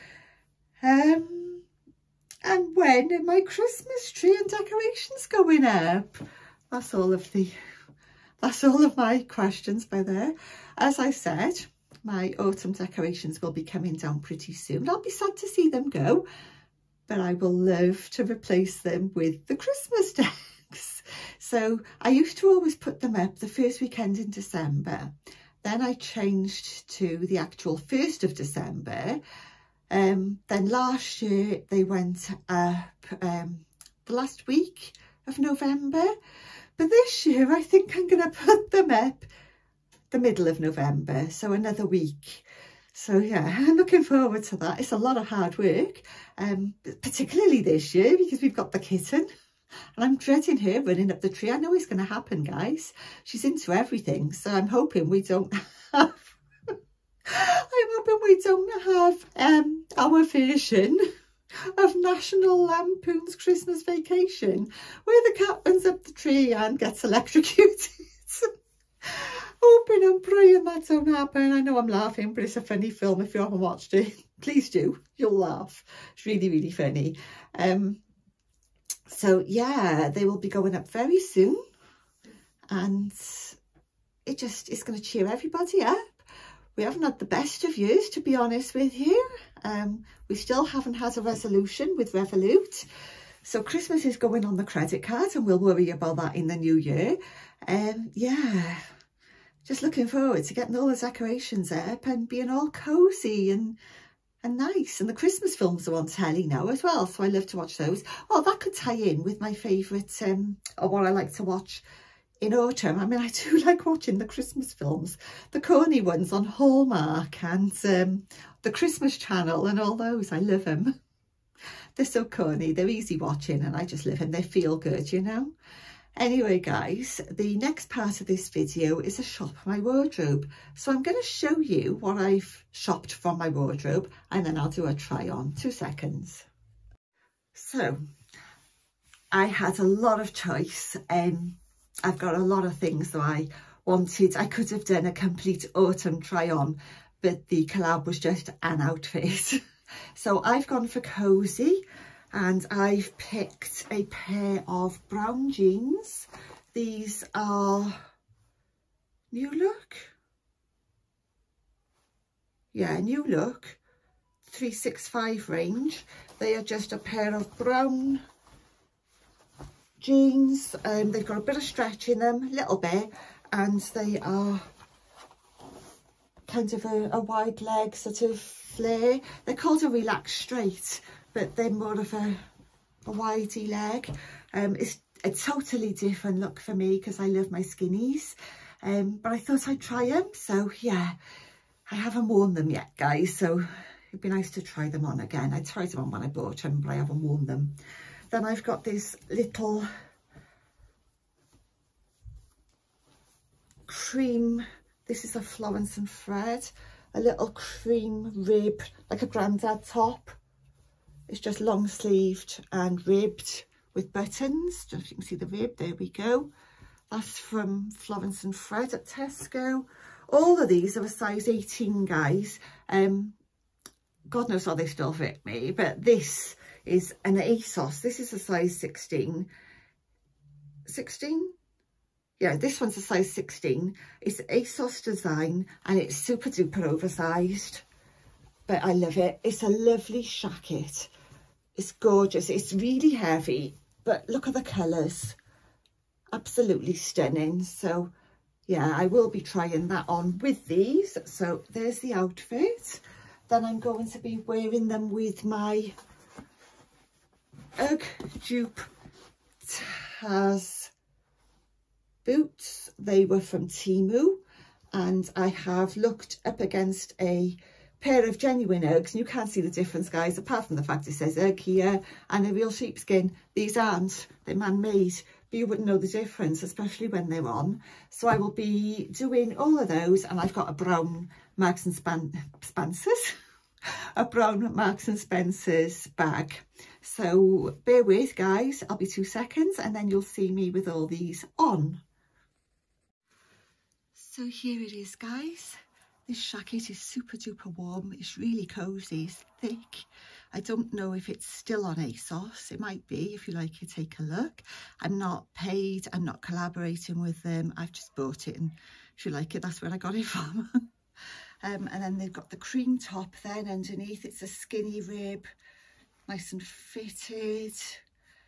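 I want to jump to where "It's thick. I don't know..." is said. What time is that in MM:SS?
04:59.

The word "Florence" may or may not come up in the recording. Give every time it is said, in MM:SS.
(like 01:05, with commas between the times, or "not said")
03:25, 03:37.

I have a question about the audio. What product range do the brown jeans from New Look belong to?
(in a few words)
365.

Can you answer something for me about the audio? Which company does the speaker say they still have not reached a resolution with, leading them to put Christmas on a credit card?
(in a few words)
Revolut.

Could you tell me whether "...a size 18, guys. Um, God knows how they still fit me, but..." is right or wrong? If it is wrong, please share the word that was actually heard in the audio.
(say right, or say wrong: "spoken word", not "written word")
right.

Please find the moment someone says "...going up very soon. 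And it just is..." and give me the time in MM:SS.
01:20.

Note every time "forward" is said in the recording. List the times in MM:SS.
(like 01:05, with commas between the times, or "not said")
00:44, 01:40.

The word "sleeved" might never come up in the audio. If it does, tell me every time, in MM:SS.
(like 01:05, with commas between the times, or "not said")
03:31.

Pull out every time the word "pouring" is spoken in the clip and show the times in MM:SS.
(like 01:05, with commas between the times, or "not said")
not said.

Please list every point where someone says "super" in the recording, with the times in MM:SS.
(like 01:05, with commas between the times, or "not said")
03:56, 04:57.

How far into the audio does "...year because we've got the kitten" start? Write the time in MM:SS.
00:47.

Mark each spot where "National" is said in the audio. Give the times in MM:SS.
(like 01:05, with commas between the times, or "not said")
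01:01.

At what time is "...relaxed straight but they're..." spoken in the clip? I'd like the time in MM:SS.
02:59.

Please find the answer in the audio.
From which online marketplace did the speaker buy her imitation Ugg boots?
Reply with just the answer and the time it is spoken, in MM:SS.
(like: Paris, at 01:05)
Temu, at 04:23.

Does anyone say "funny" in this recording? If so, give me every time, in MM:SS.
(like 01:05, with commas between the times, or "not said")
01:12, 01:16.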